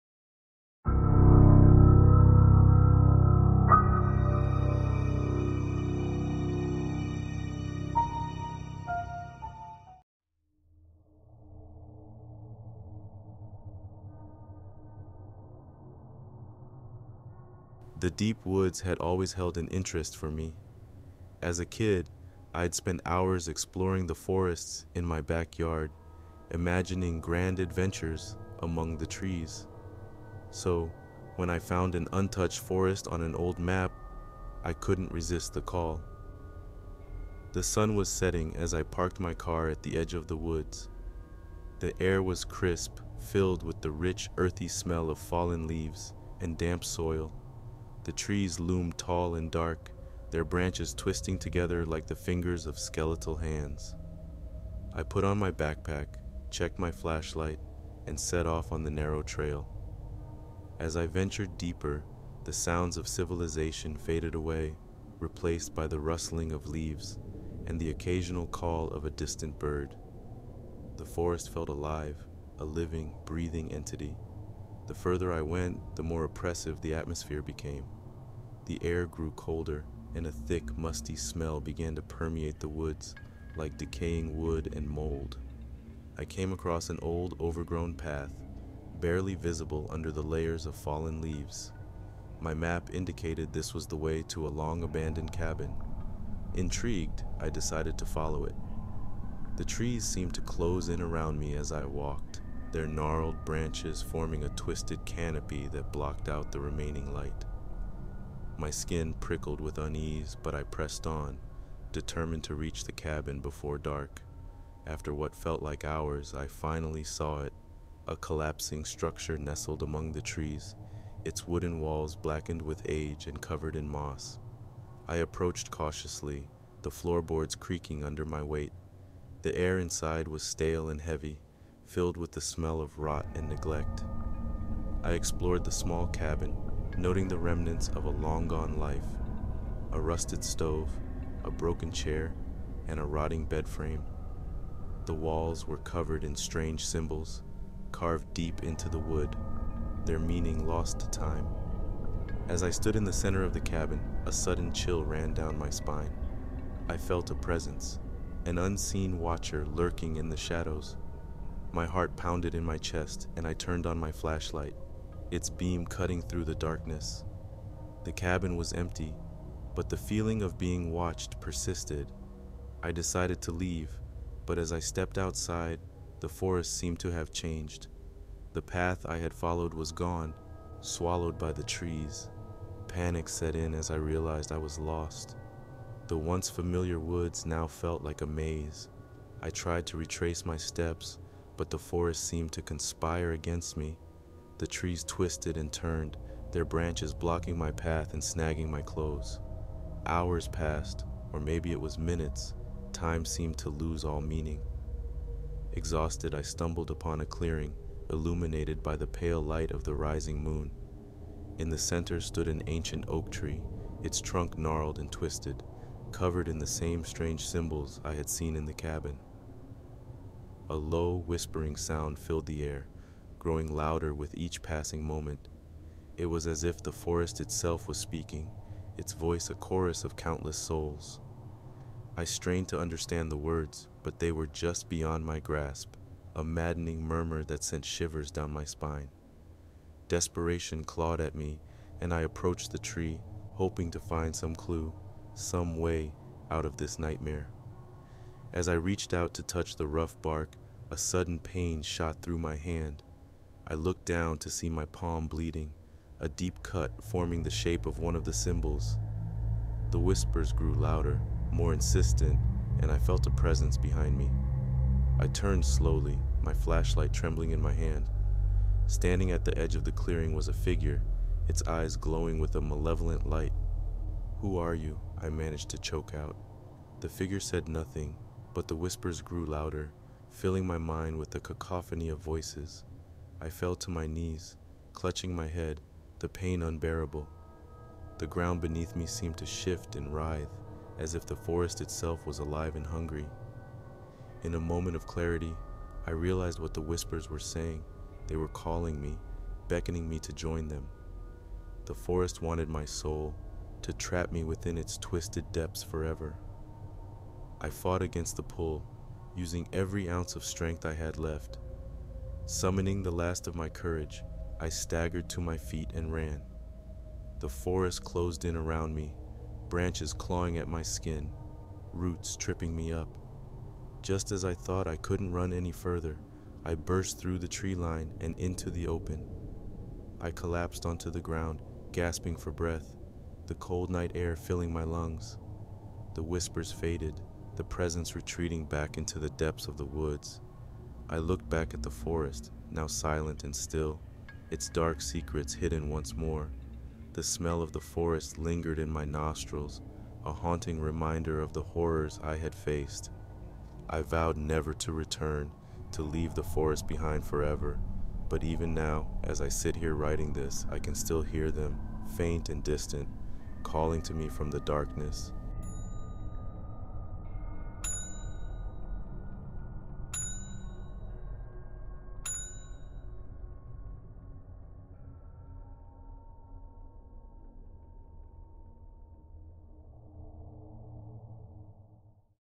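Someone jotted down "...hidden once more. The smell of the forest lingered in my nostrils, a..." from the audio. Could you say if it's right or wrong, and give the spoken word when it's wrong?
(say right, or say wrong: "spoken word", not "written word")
right.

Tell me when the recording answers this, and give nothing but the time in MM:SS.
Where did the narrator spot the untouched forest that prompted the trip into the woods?
00:33.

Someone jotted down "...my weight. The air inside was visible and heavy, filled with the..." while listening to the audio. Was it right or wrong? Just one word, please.
wrong.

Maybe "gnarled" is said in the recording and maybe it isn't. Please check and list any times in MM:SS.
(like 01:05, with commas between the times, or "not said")
01:42, 03:34.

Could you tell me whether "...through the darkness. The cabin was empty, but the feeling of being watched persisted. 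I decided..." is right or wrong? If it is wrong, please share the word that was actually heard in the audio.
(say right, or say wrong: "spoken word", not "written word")
right.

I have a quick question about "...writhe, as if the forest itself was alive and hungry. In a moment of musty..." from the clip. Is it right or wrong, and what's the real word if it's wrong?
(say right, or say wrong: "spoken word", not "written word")
wrong: "clarity", not "musty".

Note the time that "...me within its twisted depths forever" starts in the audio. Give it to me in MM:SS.
05:04.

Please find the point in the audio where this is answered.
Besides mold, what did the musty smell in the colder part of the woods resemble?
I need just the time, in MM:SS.
01:23.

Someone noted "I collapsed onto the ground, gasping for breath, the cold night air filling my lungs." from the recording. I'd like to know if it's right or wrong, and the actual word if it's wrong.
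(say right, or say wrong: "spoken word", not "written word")
right.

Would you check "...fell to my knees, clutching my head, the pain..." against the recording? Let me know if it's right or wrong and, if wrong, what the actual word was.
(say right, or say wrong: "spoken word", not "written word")
right.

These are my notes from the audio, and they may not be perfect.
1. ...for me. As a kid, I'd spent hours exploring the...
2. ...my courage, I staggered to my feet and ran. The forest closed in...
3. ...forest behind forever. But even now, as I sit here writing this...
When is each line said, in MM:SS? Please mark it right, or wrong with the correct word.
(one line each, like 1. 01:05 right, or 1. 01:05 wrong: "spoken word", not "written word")
1. 00:20 right
2. 05:13 right
3. 05:56 right.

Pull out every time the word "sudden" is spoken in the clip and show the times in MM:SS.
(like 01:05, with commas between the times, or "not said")
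02:34, 04:10.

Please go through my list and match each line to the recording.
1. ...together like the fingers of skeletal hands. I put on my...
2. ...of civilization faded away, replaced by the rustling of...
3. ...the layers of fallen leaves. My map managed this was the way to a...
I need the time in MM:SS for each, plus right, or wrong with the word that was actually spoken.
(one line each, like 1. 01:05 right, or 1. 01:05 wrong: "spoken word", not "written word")
1. 00:51 right
2. 01:02 right
3. 01:30 wrong: "indicated", not "managed".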